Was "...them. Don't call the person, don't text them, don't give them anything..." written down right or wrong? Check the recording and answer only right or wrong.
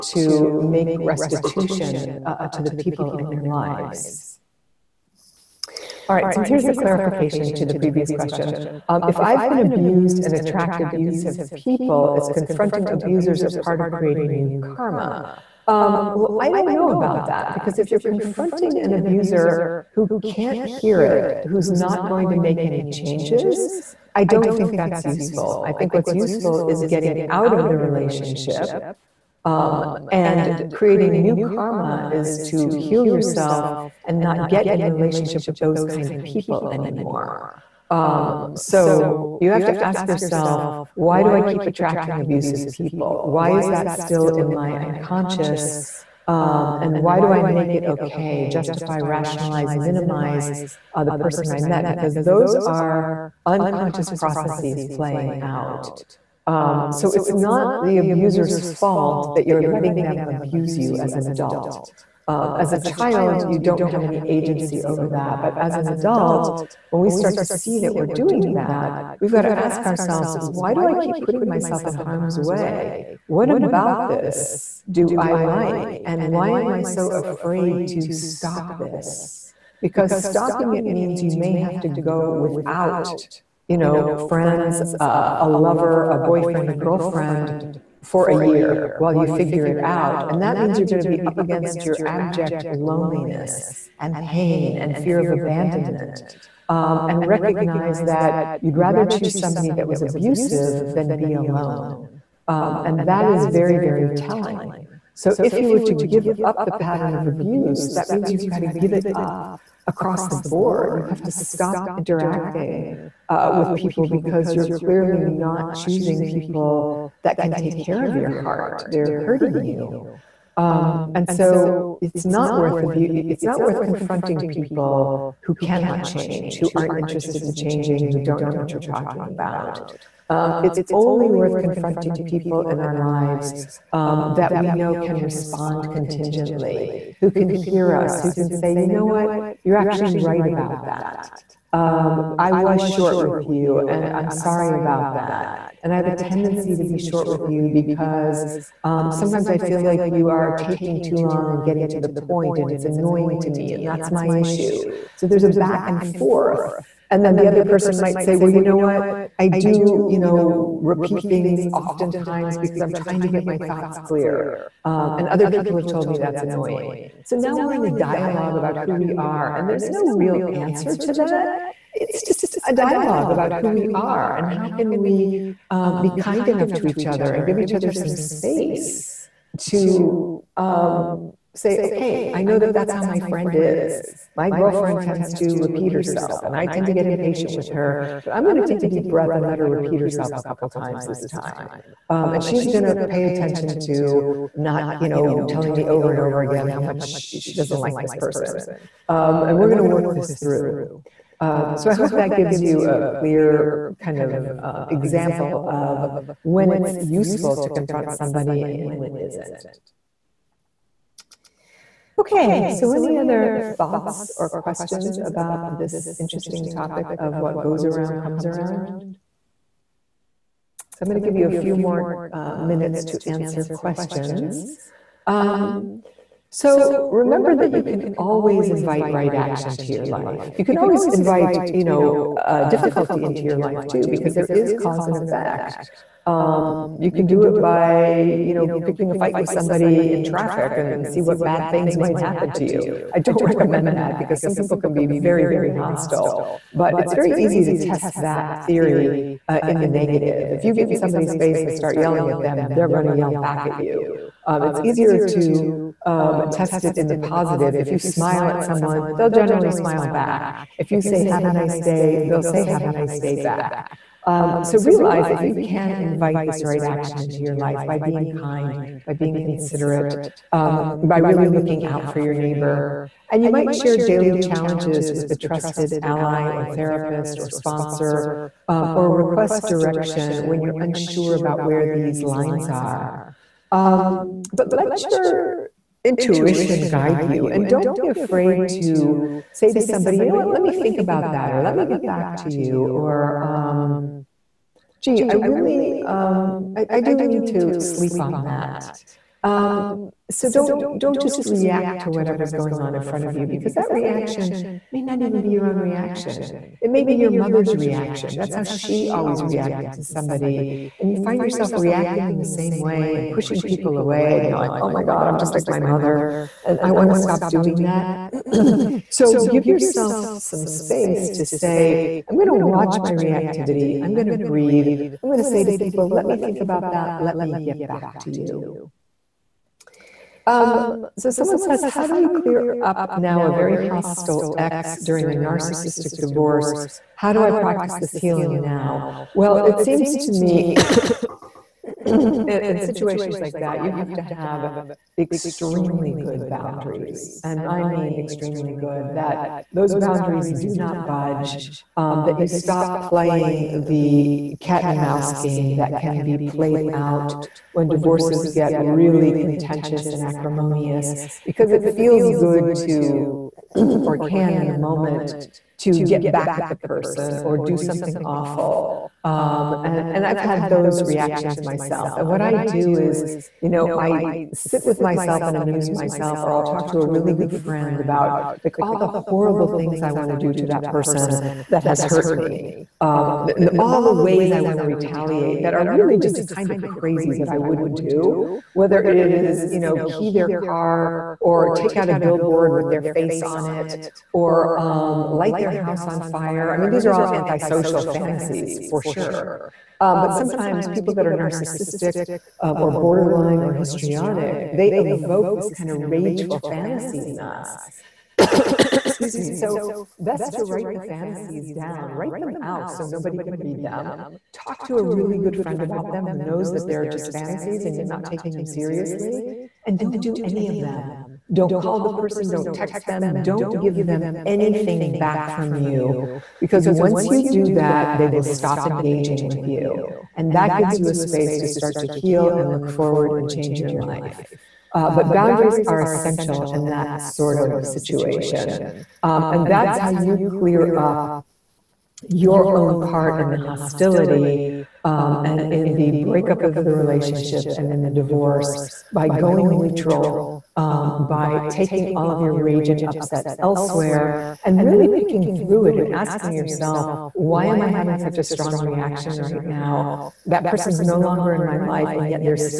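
right.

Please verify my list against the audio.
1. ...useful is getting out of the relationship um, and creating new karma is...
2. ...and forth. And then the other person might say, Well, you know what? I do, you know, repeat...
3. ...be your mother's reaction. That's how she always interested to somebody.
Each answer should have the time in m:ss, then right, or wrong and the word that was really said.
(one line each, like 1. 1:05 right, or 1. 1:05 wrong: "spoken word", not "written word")
1. 0:26 right
2. 2:35 right
3. 5:07 wrong: "reacted", not "interested".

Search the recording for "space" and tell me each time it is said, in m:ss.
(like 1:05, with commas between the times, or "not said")
2:58, 5:20, 7:11.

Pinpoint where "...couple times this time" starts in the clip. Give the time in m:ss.
3:10.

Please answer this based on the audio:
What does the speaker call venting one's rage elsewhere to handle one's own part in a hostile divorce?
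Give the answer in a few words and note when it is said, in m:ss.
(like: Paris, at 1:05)
going neutral, at 7:29.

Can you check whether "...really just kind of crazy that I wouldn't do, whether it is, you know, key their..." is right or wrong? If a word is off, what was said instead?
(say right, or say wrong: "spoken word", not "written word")
right.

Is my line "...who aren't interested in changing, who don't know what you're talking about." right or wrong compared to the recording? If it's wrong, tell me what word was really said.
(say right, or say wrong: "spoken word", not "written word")
right.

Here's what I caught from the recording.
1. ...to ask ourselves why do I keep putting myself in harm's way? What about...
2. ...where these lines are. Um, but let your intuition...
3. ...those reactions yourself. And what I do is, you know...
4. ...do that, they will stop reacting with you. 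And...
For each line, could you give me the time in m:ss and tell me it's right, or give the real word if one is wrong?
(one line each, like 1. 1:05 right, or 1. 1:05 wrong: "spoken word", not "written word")
1. 1:09 right
2. 4:41 right
3. 6:10 wrong: "myself", not "yourself"
4. 7:07 wrong: "engaging", not "reacting".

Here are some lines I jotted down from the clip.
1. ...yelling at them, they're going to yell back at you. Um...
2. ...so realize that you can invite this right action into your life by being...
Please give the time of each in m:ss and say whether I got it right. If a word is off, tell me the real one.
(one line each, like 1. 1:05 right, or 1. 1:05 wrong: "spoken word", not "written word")
1. 4:11 right
2. 4:24 right.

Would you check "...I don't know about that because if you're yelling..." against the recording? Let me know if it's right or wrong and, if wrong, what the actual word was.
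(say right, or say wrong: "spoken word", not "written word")
wrong: "confronting", not "yelling".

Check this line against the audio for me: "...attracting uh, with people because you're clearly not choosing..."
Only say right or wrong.
wrong.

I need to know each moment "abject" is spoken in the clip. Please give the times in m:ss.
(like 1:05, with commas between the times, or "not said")
1:32.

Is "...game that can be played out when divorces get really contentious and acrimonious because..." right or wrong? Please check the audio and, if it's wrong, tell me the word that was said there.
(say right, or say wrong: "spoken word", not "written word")
right.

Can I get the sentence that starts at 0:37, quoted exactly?
Um, so you have to ask yourself, why do I keep attracting abusive people?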